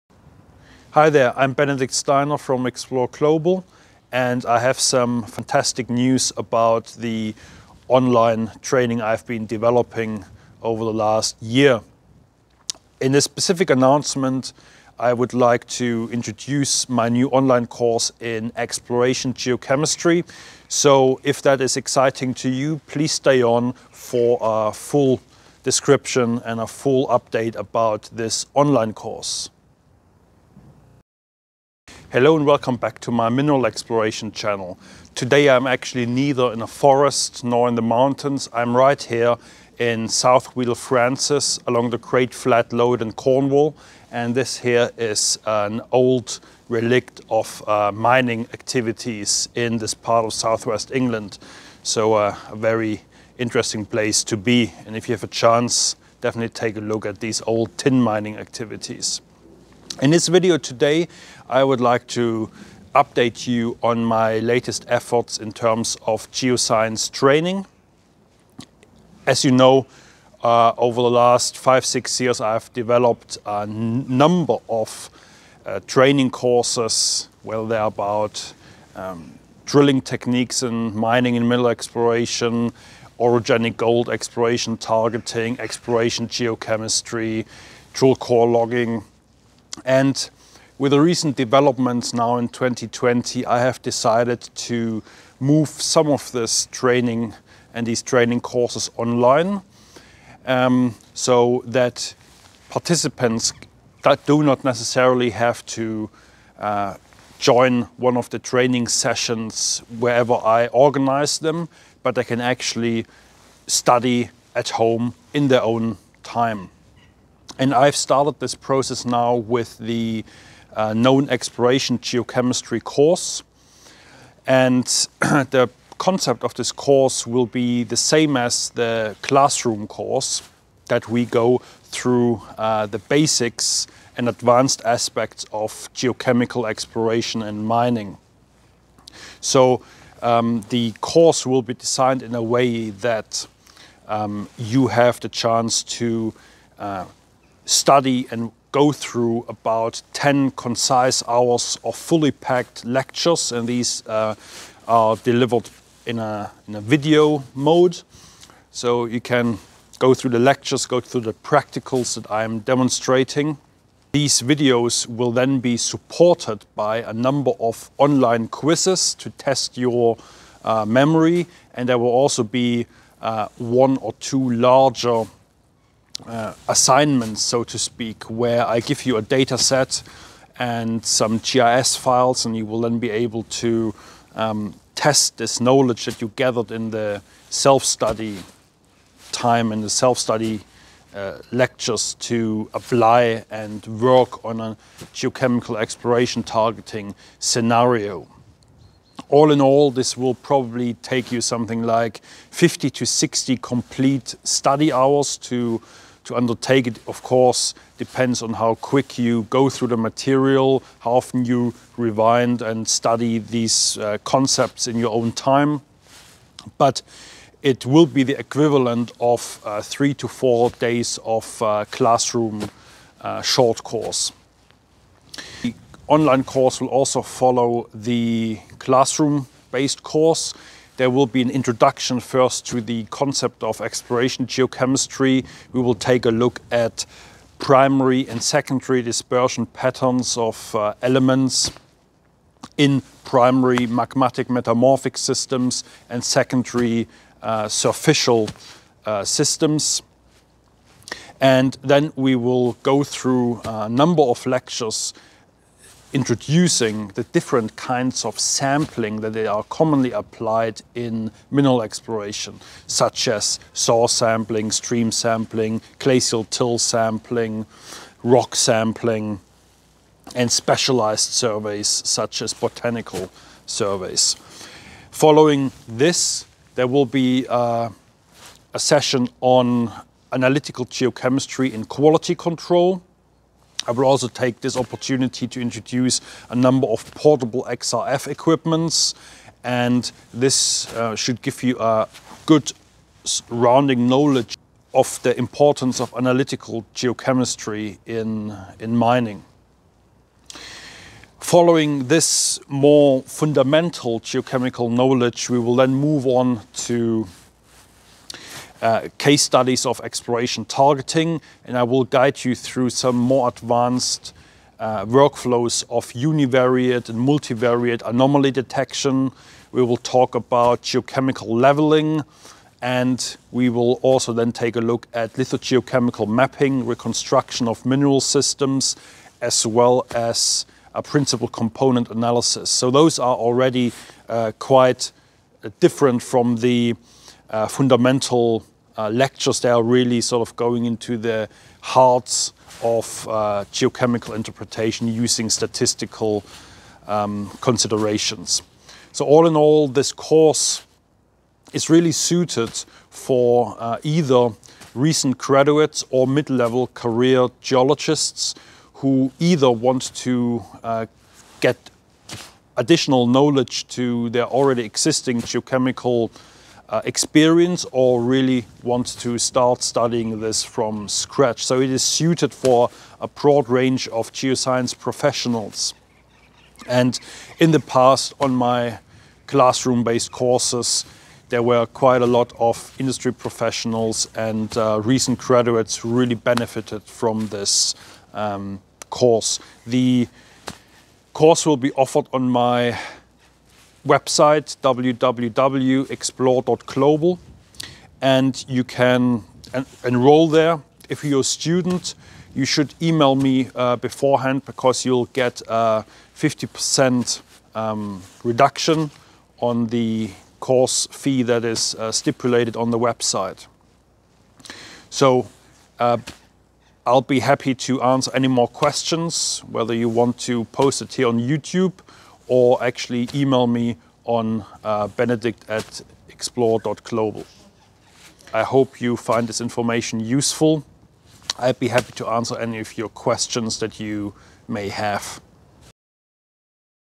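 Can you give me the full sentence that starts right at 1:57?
And I've started this process now with the uh, known exploration geochemistry course.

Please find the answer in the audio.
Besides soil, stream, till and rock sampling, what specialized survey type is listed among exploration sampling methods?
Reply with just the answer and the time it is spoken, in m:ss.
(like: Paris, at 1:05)
Botanical surveys, at 4:32.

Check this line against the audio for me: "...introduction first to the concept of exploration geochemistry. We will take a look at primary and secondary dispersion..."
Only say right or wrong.
right.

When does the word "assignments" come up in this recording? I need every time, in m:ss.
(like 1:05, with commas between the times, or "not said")
2:56.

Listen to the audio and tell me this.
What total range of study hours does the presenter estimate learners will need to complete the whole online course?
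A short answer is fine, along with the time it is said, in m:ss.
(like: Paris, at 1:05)
50 to 60, at 3:22.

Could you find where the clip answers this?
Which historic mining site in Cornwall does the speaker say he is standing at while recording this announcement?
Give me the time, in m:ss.
0:40.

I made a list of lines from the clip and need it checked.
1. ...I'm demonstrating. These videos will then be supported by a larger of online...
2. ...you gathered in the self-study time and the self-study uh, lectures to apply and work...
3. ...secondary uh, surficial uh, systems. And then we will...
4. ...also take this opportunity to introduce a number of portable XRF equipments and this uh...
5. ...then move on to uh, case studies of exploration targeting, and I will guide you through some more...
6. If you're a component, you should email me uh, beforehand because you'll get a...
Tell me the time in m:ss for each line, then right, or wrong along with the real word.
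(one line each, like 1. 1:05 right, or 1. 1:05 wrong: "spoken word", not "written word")
1. 2:42 wrong: "number", not "larger"
2. 3:06 right
3. 4:06 right
4. 4:44 right
5. 5:05 right
6. 6:41 wrong: "student", not "component".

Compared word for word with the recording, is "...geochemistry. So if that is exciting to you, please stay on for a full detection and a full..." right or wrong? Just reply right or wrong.
wrong.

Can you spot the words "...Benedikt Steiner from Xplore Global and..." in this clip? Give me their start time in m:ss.
0:01.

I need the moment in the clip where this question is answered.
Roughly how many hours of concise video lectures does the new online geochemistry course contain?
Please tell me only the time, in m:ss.
2:30.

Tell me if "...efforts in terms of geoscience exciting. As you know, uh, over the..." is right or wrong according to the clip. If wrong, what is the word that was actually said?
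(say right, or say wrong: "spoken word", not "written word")
wrong: "training", not "exciting".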